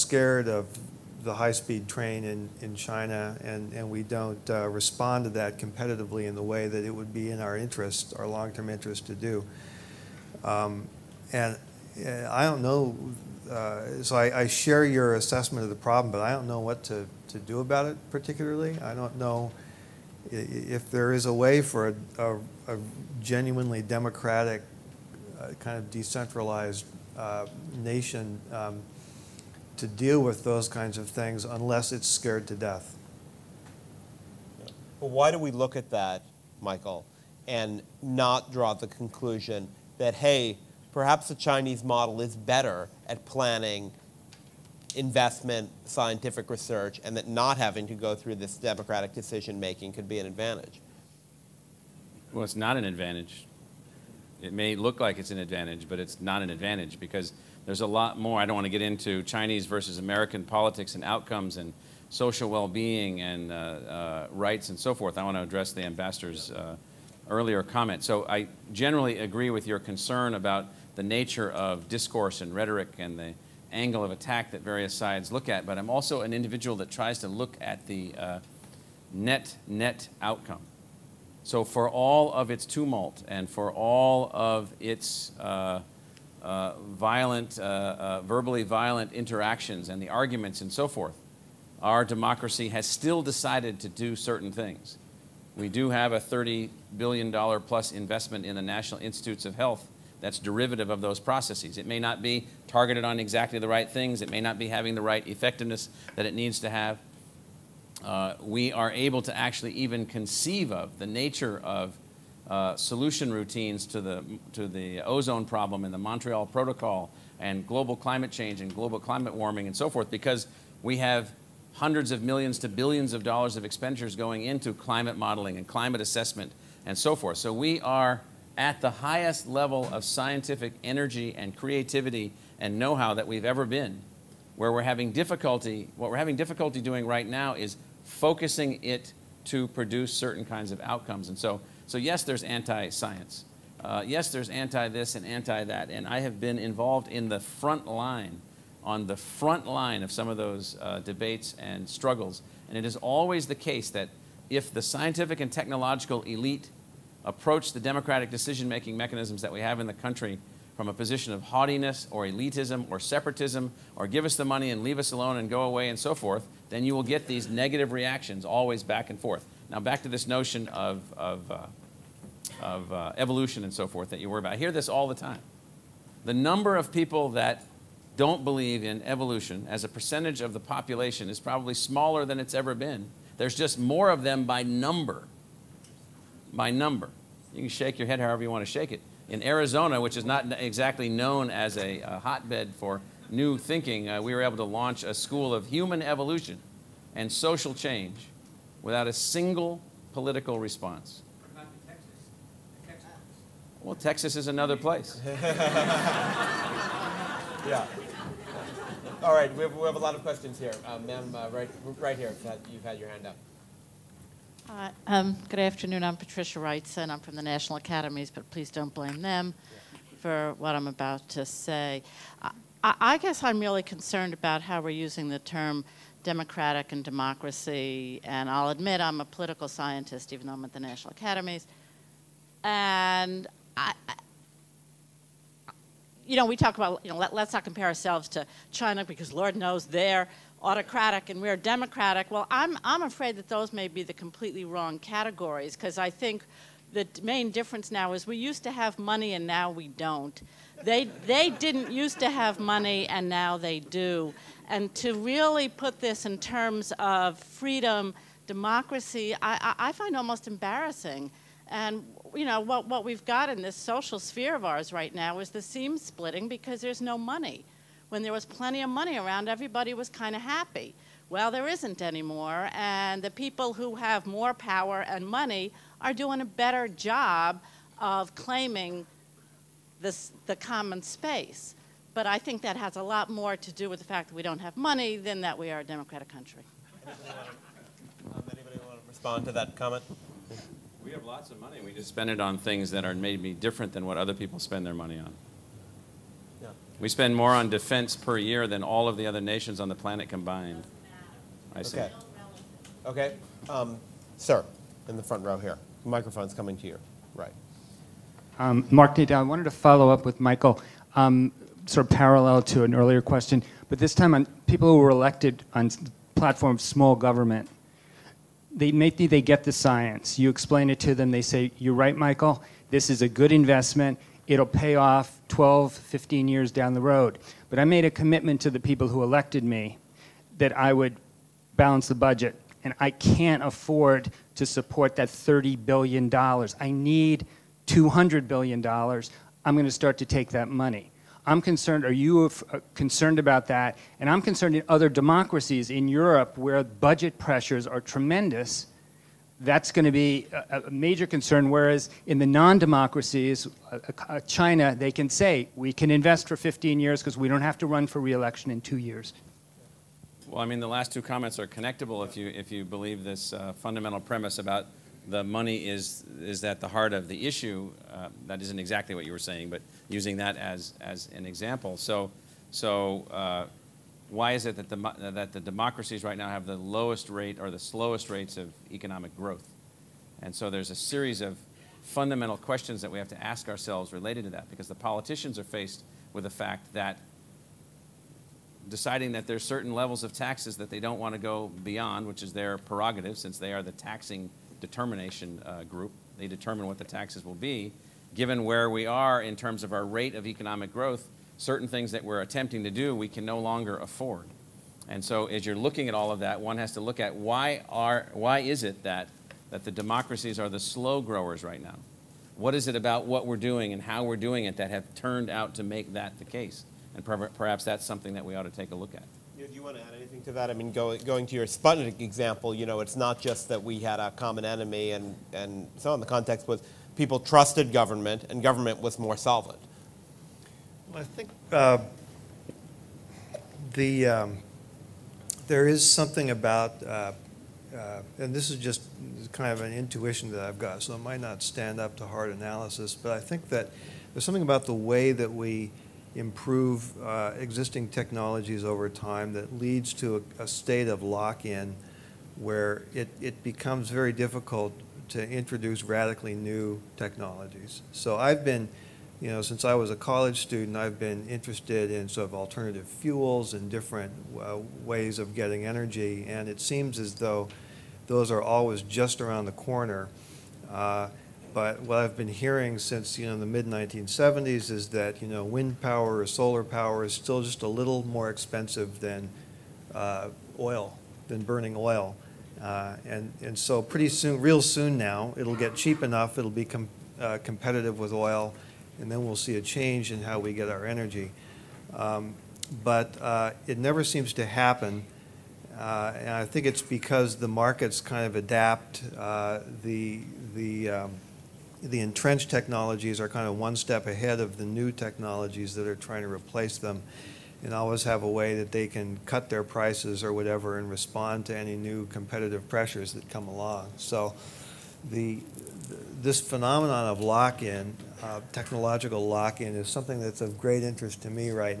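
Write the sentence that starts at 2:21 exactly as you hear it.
And so, so yes, there's anti-science.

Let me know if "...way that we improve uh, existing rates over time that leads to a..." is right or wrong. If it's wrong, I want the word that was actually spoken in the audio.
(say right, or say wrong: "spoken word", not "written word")
wrong: "technologies", not "rates".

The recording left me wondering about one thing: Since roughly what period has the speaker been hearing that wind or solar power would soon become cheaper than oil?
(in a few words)
mid 1970s.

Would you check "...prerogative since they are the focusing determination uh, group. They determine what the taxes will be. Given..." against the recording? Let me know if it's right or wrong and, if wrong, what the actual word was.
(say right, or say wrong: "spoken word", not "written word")
wrong: "taxing", not "focusing".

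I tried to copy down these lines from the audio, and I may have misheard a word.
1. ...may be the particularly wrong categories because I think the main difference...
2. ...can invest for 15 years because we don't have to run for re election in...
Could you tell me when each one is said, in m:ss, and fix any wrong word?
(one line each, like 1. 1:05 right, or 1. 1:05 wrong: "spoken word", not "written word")
1. 4:03 wrong: "completely", not "particularly"
2. 5:55 right.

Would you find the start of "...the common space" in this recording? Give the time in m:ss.
4:40.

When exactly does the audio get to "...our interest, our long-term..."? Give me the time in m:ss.
0:07.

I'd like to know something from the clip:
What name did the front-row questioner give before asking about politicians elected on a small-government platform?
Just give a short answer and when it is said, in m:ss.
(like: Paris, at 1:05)
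Mark Nadal, at 5:08.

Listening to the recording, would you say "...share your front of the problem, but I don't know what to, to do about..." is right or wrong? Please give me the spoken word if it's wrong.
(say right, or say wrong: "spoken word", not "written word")
wrong: "assessment", not "front".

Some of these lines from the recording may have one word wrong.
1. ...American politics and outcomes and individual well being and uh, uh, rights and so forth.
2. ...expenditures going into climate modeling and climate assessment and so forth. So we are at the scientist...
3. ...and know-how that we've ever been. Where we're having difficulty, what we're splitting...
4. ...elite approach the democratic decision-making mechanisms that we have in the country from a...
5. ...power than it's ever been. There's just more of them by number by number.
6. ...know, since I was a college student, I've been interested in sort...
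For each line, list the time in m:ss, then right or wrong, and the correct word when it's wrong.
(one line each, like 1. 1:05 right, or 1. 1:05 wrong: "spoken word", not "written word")
1. 0:59 wrong: "social", not "individual"
2. 2:03 wrong: "highest", not "scientist"
3. 2:12 wrong: "having", not "splitting"
4. 2:36 right
5. 3:01 wrong: "smaller", not "power"
6. 7:39 right.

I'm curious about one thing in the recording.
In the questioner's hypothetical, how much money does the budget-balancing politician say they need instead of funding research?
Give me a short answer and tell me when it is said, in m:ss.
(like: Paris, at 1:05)
$200 billion, at 5:37.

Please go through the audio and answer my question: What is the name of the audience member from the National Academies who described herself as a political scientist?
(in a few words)
Patricia Wrightson.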